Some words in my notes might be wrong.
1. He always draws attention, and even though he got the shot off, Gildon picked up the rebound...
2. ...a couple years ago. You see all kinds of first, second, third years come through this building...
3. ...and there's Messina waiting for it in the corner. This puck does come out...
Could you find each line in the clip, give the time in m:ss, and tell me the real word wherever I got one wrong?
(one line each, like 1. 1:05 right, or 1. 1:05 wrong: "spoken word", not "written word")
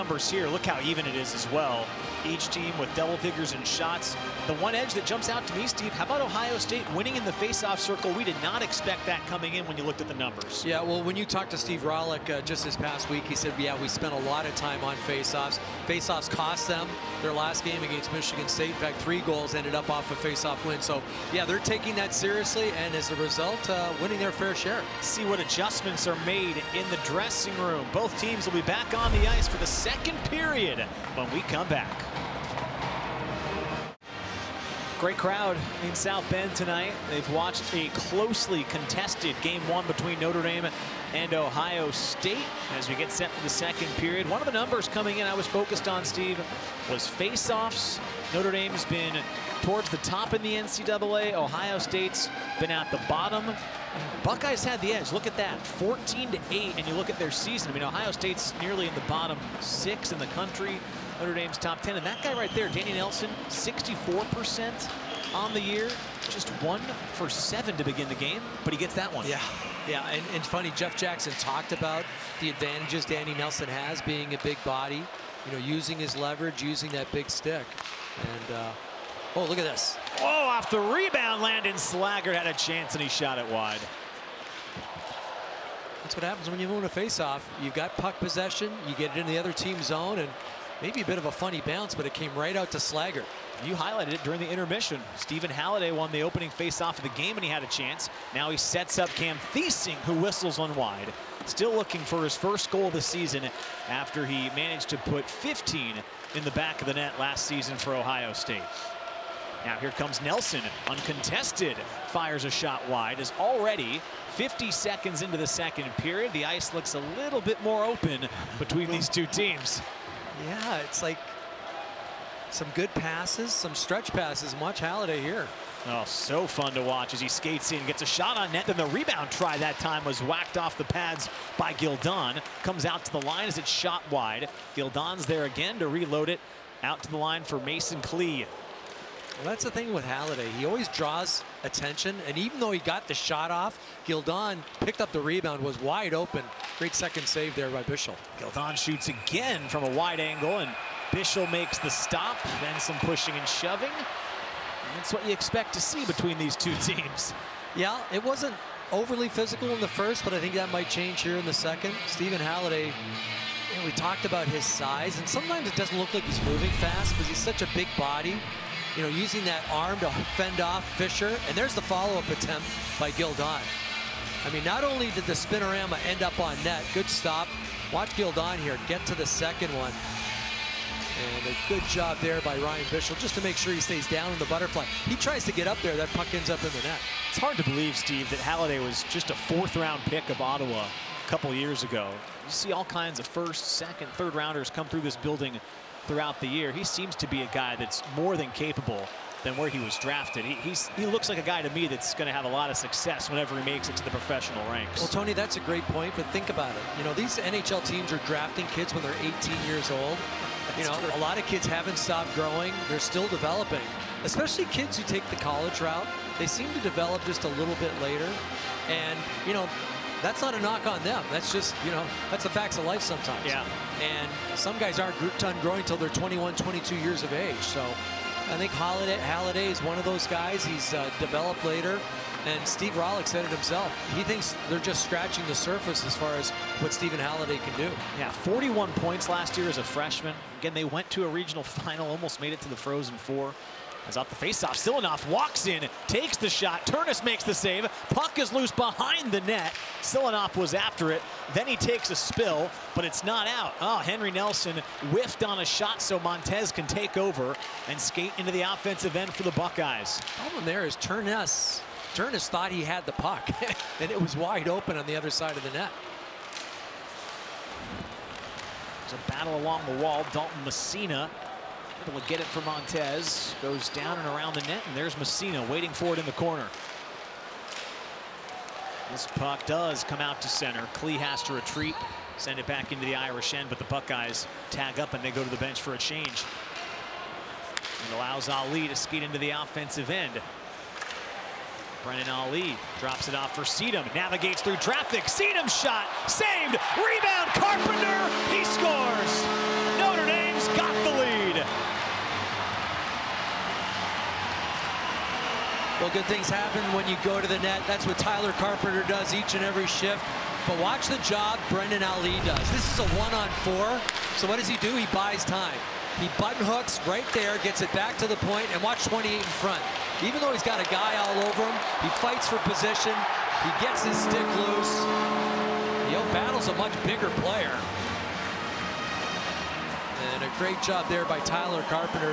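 1. 2:20 right
2. 3:10 wrong: "rounders", not "years"
3. 4:34 right.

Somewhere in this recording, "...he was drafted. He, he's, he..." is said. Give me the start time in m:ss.
3:19.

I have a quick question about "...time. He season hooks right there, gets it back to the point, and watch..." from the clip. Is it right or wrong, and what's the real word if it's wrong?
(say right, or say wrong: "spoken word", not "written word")
wrong: "button", not "season".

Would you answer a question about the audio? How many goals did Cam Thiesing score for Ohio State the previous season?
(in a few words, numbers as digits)
15.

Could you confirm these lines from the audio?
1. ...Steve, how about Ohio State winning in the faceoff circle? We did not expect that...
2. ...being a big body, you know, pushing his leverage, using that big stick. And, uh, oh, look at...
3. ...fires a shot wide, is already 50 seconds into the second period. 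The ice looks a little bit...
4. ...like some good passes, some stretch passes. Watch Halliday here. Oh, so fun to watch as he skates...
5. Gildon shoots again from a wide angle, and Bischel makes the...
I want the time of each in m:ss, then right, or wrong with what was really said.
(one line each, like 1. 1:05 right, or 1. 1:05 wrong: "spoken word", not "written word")
1. 0:05 right
2. 1:14 wrong: "using", not "pushing"
3. 1:52 right
4. 2:01 right
5. 2:28 right.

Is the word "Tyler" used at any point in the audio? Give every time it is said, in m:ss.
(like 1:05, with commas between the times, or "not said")
5:08, 5:31.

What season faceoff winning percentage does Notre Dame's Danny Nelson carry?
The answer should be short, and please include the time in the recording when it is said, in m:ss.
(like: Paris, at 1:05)
64%, at 1:03.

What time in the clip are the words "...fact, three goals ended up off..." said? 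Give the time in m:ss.
0:18.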